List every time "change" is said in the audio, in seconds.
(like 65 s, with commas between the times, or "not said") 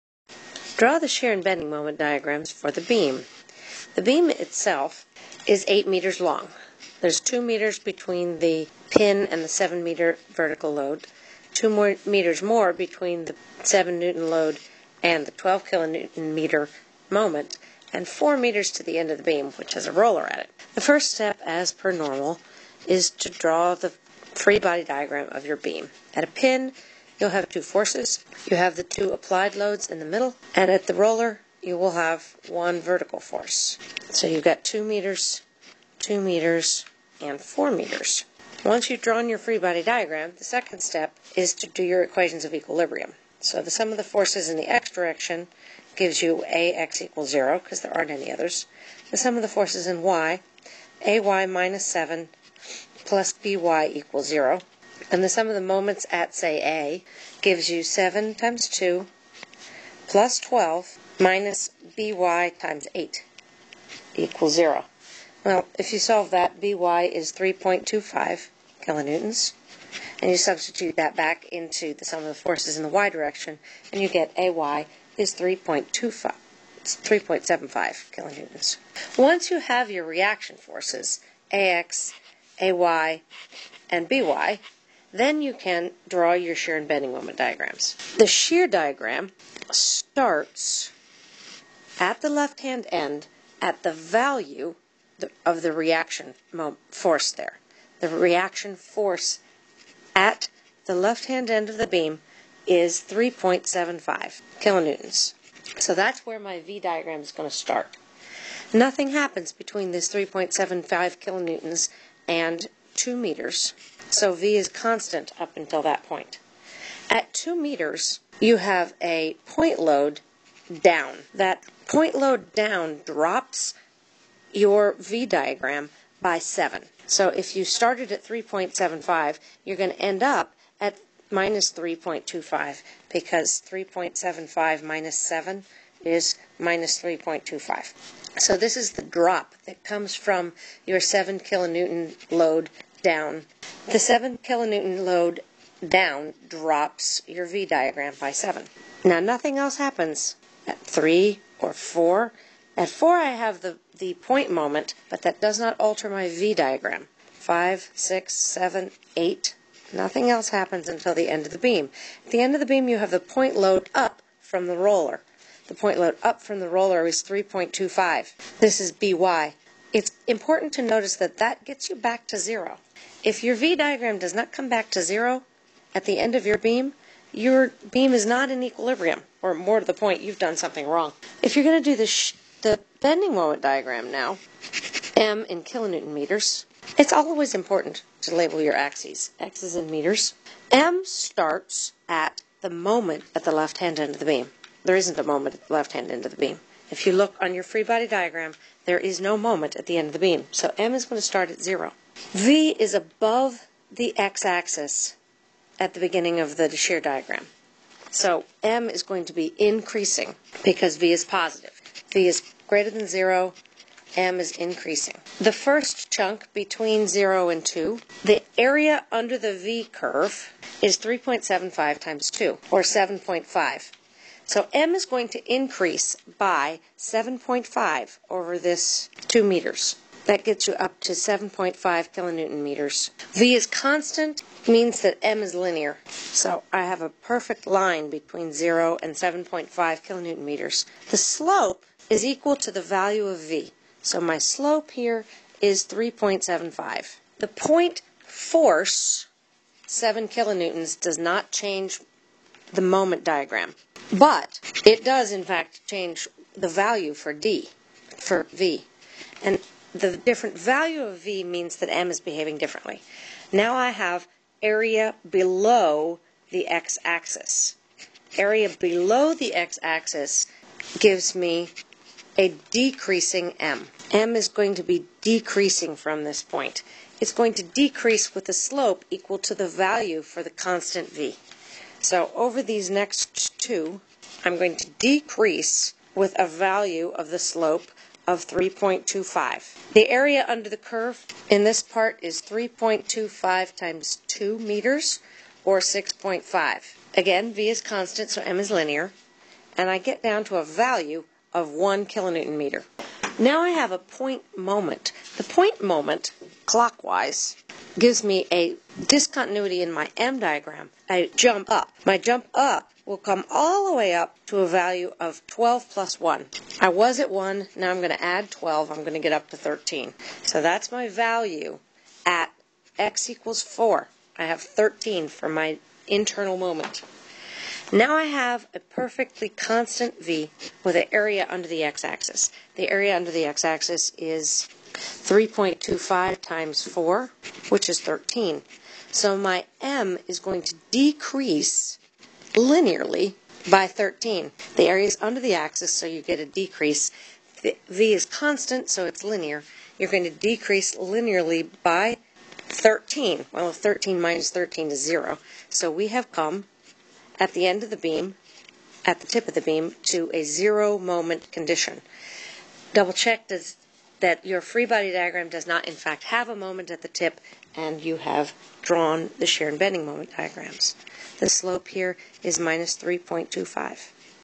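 251 s, 255 s.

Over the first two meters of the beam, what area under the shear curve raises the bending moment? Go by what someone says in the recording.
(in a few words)
7.5.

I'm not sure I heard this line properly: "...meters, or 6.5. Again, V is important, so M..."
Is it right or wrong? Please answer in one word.
wrong.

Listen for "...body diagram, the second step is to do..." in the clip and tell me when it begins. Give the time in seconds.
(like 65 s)
39 s.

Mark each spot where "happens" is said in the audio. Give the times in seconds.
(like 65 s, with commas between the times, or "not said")
109 s, 149 s, 160 s.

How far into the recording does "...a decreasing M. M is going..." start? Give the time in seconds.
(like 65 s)
272 s.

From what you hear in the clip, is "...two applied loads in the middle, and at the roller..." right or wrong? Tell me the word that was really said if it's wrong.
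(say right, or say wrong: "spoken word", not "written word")
right.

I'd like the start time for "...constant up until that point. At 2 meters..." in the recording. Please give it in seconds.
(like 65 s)
114 s.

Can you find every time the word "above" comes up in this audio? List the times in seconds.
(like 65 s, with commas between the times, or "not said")
202 s.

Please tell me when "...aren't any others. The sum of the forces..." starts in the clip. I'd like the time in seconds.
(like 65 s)
47 s.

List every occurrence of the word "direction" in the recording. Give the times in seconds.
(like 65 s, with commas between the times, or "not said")
44 s, 73 s.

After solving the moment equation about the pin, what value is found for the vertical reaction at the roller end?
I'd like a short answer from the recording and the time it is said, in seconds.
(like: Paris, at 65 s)
3.25 kilonewtons, at 66 s.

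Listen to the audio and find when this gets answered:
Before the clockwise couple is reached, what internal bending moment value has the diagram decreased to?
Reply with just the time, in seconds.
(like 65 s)
301 s.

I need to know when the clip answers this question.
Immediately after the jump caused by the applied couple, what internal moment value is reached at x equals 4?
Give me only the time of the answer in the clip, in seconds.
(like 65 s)
319 s.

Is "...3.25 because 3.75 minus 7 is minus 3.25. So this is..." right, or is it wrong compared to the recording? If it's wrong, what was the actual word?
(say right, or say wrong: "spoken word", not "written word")
right.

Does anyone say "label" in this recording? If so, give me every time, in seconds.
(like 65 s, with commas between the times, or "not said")
188 s.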